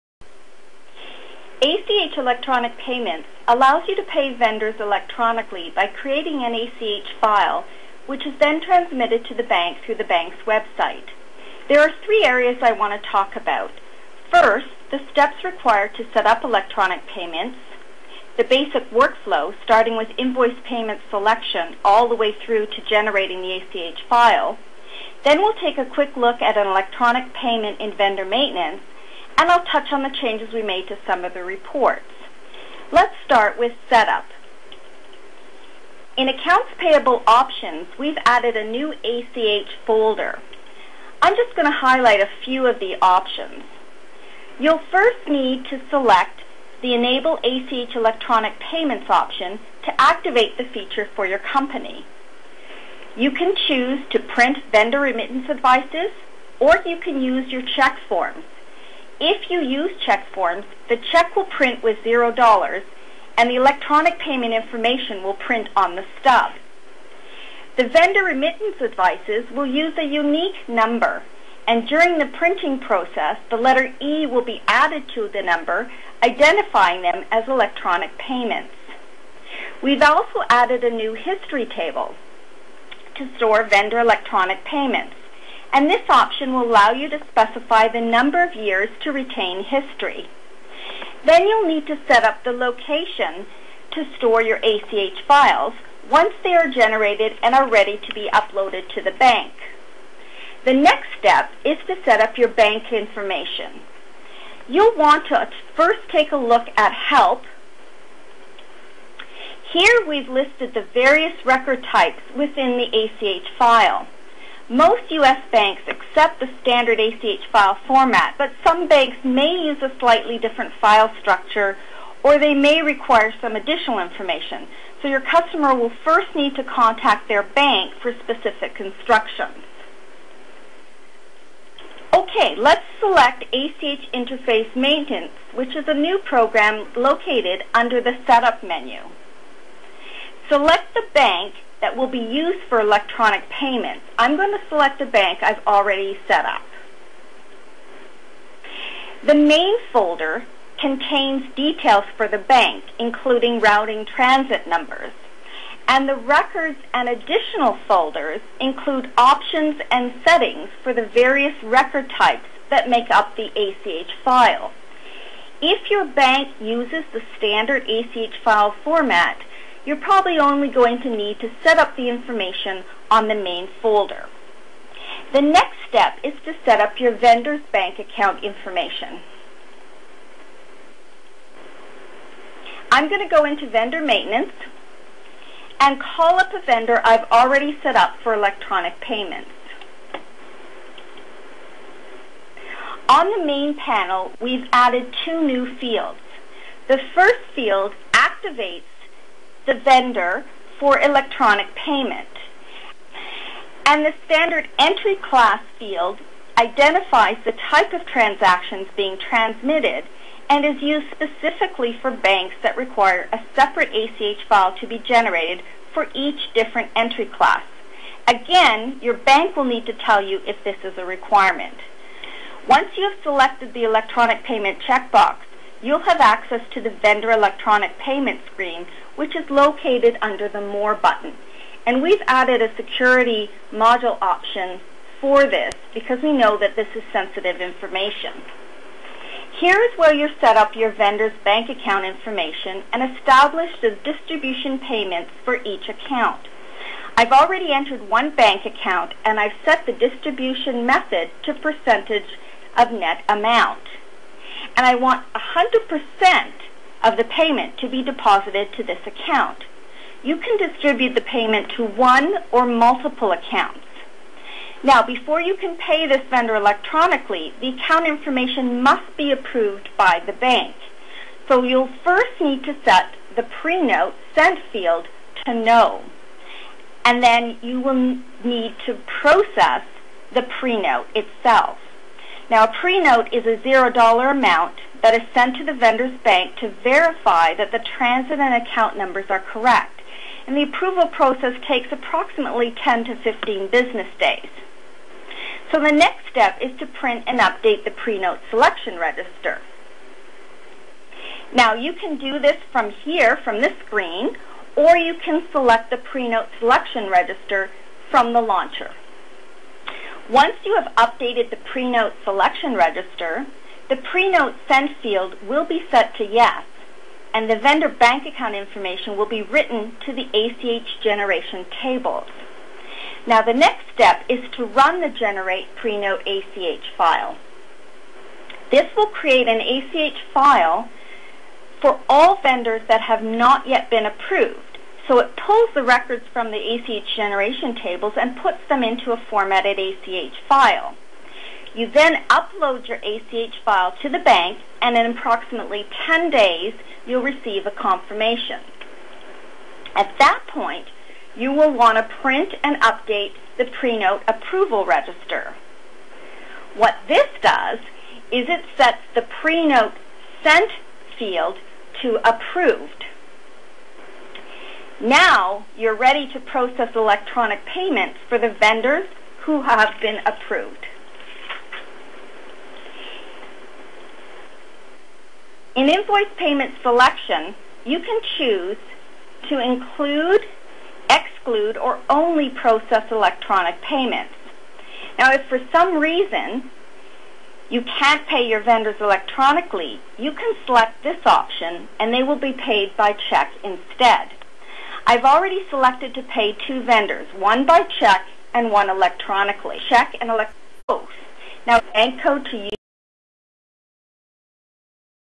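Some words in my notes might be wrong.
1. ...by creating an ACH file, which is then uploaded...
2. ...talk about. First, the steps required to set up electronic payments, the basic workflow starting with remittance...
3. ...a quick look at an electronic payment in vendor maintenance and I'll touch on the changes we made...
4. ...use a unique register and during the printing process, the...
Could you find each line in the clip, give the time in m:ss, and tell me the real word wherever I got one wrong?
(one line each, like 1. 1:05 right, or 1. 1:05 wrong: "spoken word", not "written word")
1. 0:05 wrong: "transmitted", not "uploaded"
2. 0:13 wrong: "invoice", not "remittance"
3. 0:25 right
4. 1:09 wrong: "number", not "register".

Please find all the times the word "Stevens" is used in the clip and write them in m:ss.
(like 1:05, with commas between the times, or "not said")
not said.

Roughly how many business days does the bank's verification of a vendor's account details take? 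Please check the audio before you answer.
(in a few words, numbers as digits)
10 to 15.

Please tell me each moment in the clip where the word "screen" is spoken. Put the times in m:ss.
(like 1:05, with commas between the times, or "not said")
3:48, 5:03.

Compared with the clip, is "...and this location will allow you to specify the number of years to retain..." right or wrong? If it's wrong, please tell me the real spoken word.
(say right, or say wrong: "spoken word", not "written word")
wrong: "option", not "location".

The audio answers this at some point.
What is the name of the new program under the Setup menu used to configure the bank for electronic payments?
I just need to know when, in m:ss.
2:13.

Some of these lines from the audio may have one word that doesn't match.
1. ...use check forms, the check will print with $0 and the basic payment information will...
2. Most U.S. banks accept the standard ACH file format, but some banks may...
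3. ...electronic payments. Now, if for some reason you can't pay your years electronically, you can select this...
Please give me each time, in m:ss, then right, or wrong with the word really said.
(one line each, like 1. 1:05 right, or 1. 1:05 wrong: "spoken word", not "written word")
1. 0:59 wrong: "electronic", not "basic"
2. 1:54 right
3. 6:23 wrong: "vendors", not "years".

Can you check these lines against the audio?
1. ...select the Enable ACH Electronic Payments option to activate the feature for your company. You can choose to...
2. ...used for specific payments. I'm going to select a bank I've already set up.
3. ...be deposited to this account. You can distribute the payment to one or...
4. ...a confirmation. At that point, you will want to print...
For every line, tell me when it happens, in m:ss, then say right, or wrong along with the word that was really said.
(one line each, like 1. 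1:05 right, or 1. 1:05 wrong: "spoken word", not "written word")
1. 0:45 right
2. 2:22 wrong: "electronic", not "specific"
3. 4:17 right
4. 5:47 right.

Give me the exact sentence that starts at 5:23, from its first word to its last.
Now the next step is to run the generate pre-note ACH file.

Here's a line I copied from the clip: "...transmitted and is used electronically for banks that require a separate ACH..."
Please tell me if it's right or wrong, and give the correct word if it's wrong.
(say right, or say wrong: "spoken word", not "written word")
wrong: "specifically", not "electronically".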